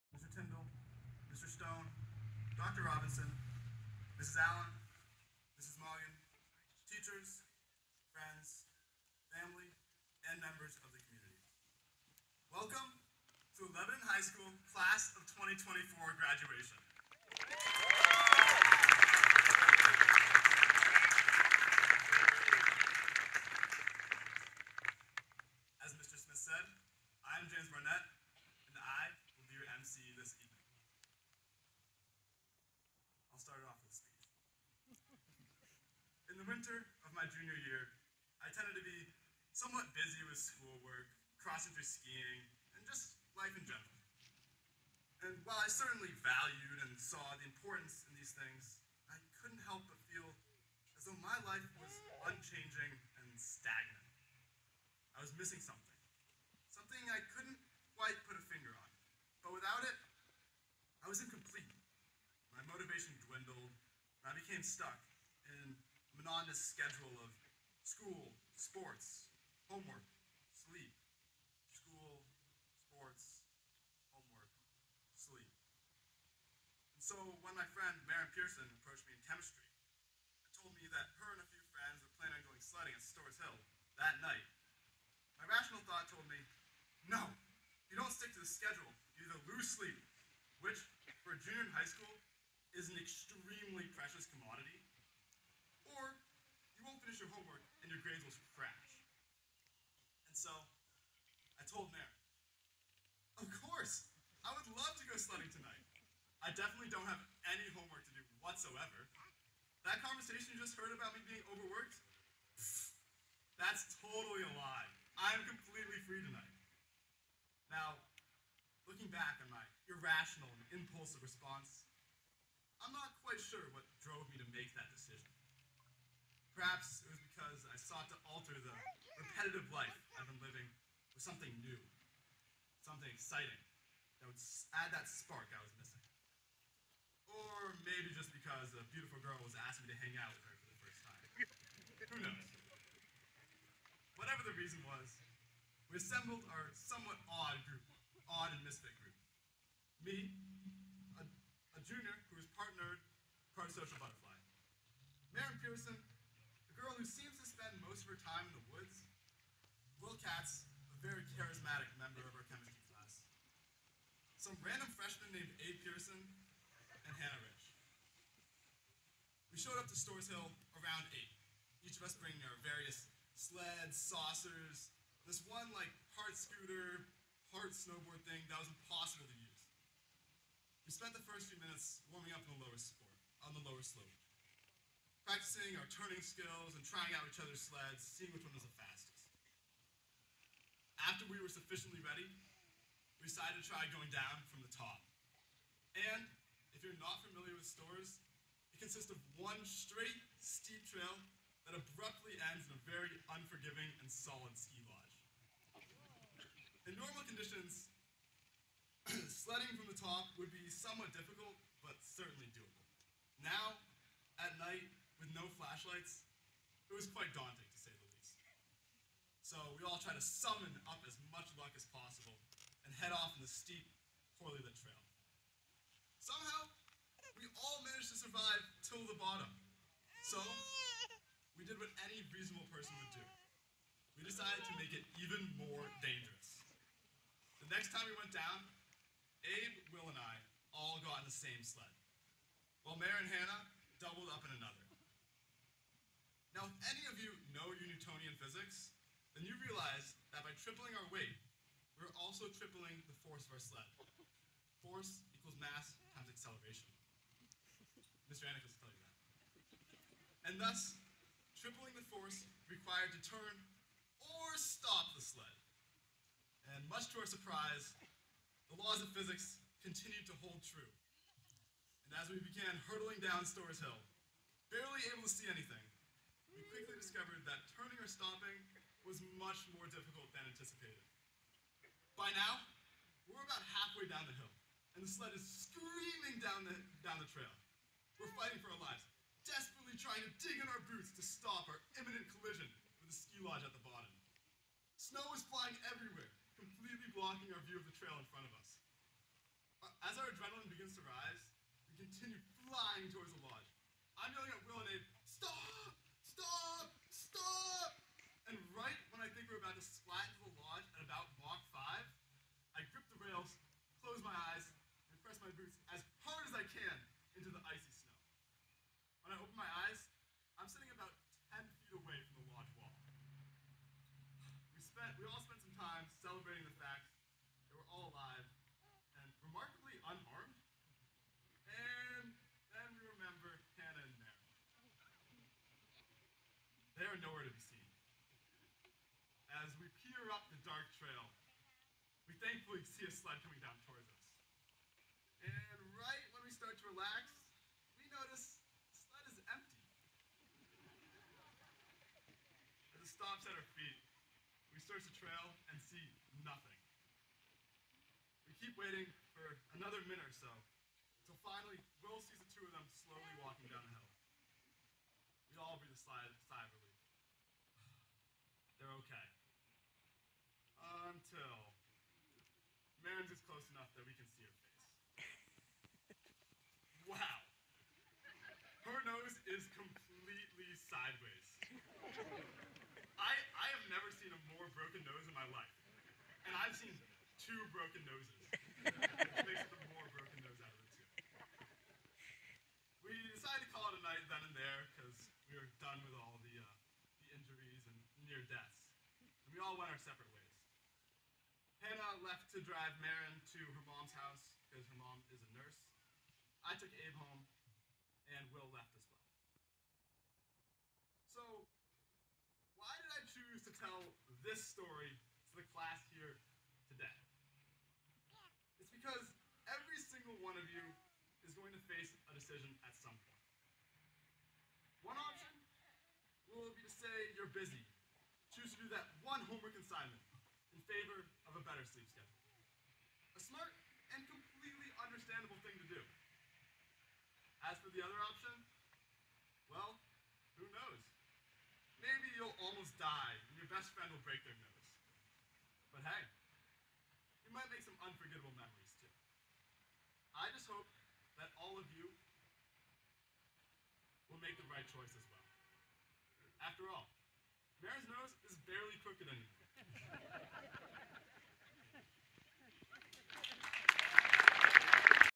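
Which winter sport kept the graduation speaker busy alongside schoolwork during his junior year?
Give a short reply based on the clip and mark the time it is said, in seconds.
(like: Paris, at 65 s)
cross-country skiing, at 41 s.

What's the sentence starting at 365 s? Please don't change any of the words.
We all breathe a sigh of relief.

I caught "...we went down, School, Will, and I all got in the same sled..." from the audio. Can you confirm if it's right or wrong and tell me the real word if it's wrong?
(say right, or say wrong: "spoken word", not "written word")
wrong: "Abe", not "School".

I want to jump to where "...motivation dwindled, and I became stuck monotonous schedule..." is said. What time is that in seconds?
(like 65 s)
62 s.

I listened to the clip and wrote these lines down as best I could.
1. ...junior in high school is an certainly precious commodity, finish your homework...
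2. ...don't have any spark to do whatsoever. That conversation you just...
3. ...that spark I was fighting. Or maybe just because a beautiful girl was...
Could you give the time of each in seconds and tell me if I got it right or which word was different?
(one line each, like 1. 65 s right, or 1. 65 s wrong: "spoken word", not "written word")
1. 91 s wrong: "extremely", not "certainly"
2. 106 s wrong: "homework", not "spark"
3. 134 s wrong: "missing", not "fighting".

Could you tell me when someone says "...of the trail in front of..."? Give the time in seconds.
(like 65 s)
297 s.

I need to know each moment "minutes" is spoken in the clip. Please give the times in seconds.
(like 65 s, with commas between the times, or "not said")
181 s, 360 s.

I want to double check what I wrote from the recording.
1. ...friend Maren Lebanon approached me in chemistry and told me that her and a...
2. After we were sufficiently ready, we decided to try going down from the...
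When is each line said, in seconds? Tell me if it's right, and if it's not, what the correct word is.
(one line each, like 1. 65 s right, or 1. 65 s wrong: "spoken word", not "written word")
1. 77 s wrong: "Pearson", not "Lebanon"
2. 190 s right.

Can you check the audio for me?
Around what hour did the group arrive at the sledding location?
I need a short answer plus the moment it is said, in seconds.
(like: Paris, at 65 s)
8, at 170 s.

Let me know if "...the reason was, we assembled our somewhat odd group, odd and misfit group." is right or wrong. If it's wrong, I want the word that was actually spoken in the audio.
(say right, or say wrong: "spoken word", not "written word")
right.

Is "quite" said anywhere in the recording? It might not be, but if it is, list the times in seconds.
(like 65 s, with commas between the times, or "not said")
57 s, 123 s, 217 s.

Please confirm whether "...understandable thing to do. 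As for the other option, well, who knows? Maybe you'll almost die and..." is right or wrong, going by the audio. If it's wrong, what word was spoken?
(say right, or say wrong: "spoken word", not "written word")
right.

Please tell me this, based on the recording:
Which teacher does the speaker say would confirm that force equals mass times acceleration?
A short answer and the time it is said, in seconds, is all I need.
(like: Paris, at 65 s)
Mr. Anik, at 258 s.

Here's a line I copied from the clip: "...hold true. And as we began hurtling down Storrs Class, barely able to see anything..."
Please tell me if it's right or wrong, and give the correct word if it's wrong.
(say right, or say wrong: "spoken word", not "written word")
wrong: "Hill", not "Class".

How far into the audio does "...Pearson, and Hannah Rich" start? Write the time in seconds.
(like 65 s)
165 s.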